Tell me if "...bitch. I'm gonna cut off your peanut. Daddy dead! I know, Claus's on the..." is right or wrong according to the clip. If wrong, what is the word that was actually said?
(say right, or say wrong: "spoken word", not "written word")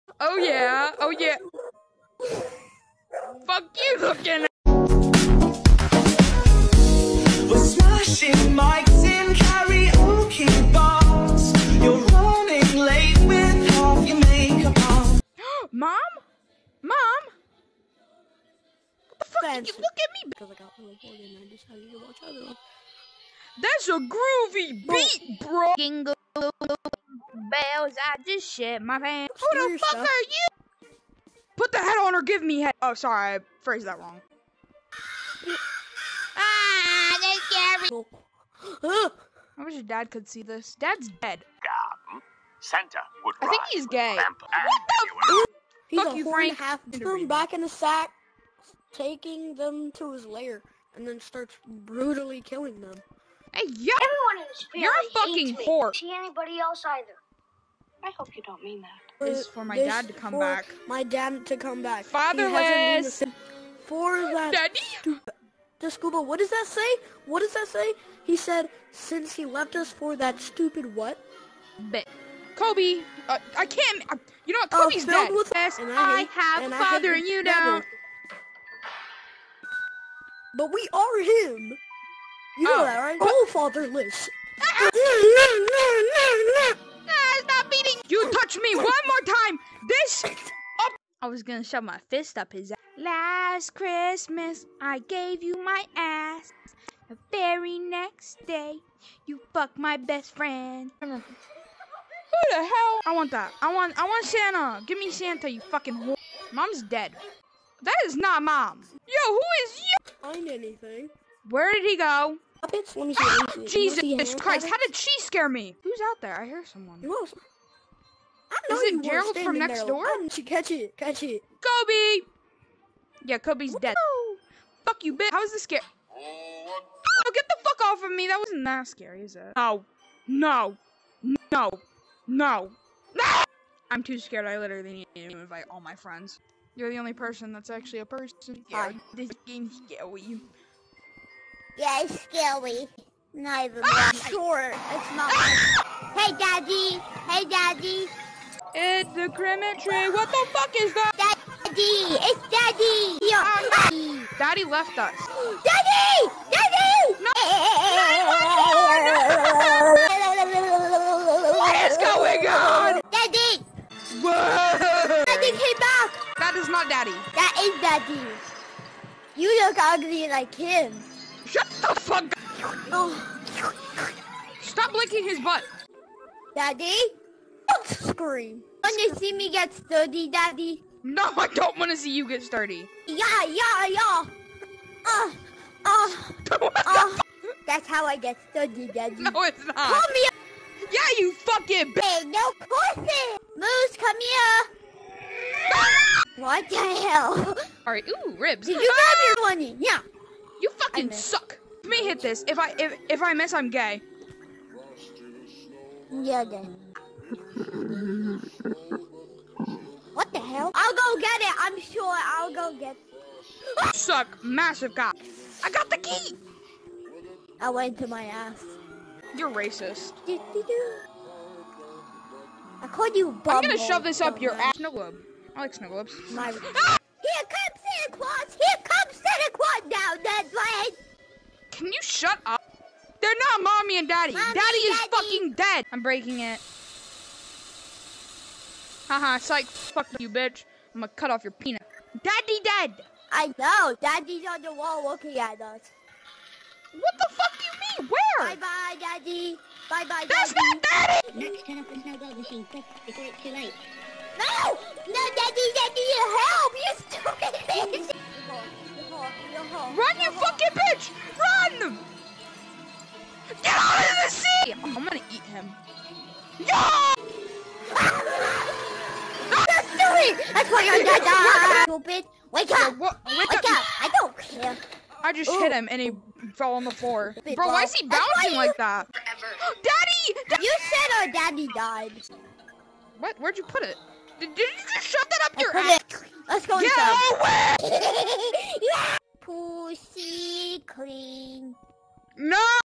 wrong: "Daddy", not "Claus".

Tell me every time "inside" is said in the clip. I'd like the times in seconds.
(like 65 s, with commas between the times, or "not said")
286 s.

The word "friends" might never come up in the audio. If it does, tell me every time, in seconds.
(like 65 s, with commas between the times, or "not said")
19 s, 100 s, 135 s.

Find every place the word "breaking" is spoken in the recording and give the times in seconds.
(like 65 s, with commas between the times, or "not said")
236 s.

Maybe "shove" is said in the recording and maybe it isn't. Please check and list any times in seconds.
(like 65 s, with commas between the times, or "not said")
91 s, 223 s, 285 s.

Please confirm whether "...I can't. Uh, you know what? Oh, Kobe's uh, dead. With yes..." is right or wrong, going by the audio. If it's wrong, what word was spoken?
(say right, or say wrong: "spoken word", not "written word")
right.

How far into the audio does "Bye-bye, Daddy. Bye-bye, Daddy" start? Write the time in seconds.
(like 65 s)
248 s.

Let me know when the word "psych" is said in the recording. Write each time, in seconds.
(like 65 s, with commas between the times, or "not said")
239 s.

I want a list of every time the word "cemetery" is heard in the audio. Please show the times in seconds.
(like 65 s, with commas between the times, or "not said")
149 s.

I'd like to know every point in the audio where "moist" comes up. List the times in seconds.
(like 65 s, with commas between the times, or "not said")
not said.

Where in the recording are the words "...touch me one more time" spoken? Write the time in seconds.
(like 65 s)
88 s.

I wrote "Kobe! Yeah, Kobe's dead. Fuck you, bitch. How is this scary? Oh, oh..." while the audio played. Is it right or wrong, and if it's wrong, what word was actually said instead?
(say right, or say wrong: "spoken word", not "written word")
right.